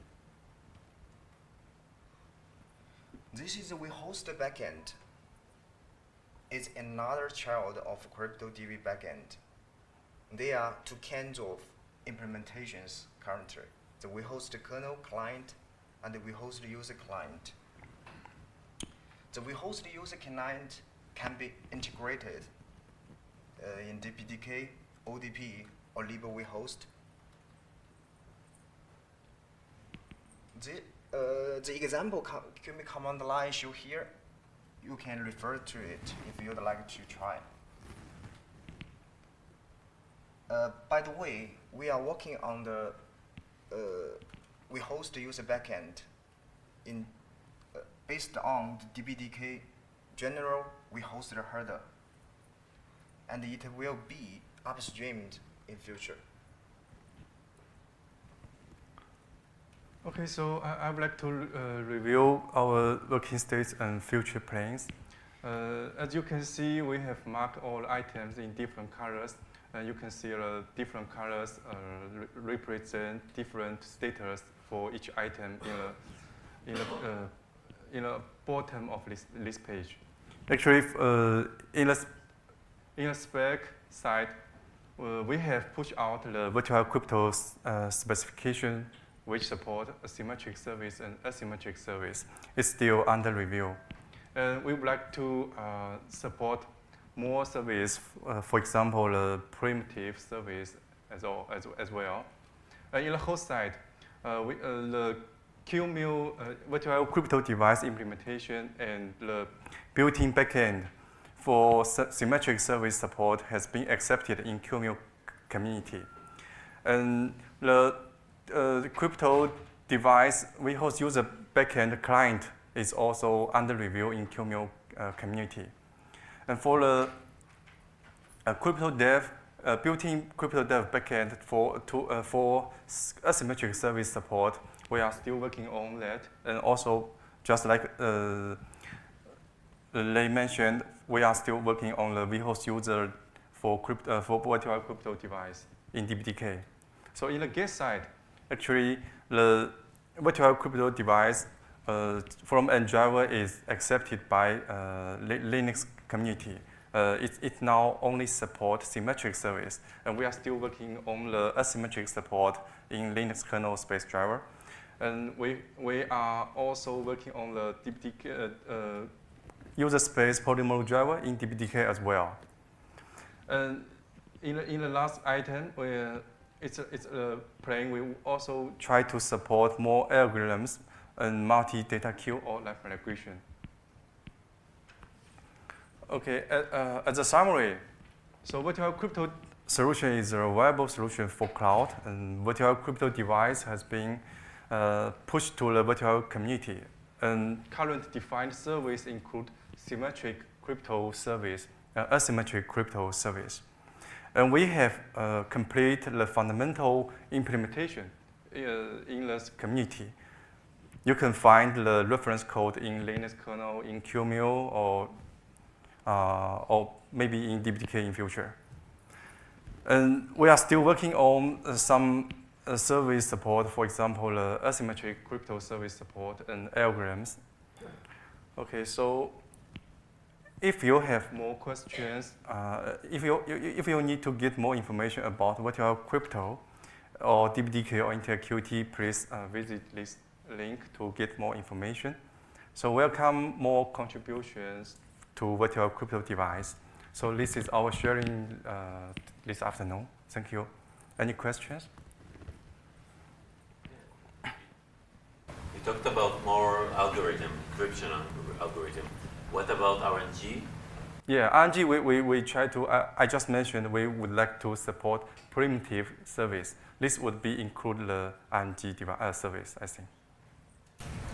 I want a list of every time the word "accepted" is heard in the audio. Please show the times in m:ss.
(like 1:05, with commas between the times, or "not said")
1:53, 2:33.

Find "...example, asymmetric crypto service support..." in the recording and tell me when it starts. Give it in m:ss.
3:43.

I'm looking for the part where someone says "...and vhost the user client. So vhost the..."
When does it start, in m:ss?
0:16.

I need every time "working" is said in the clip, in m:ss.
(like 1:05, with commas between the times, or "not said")
0:42, 1:03, 2:15, 2:21, 2:40, 2:46, 3:40.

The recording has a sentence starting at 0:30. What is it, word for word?
The, uh, the example command line show here, you can refer to it if you'd like to try.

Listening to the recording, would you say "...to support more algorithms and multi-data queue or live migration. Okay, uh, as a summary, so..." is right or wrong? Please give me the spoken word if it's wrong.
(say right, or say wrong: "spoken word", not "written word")
right.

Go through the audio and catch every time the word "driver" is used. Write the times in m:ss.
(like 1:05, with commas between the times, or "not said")
2:32, 2:44, 2:50.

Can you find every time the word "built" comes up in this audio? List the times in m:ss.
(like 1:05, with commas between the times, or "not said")
1:49, 2:09.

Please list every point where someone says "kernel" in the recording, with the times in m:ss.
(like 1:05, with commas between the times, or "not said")
0:14, 2:43, 3:33.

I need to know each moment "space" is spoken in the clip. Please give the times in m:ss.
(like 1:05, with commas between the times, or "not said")
2:43, 2:49.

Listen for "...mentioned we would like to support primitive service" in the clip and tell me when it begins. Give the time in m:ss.
4:23.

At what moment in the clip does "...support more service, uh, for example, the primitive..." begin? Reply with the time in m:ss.
1:36.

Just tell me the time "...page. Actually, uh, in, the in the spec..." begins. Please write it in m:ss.
1:19.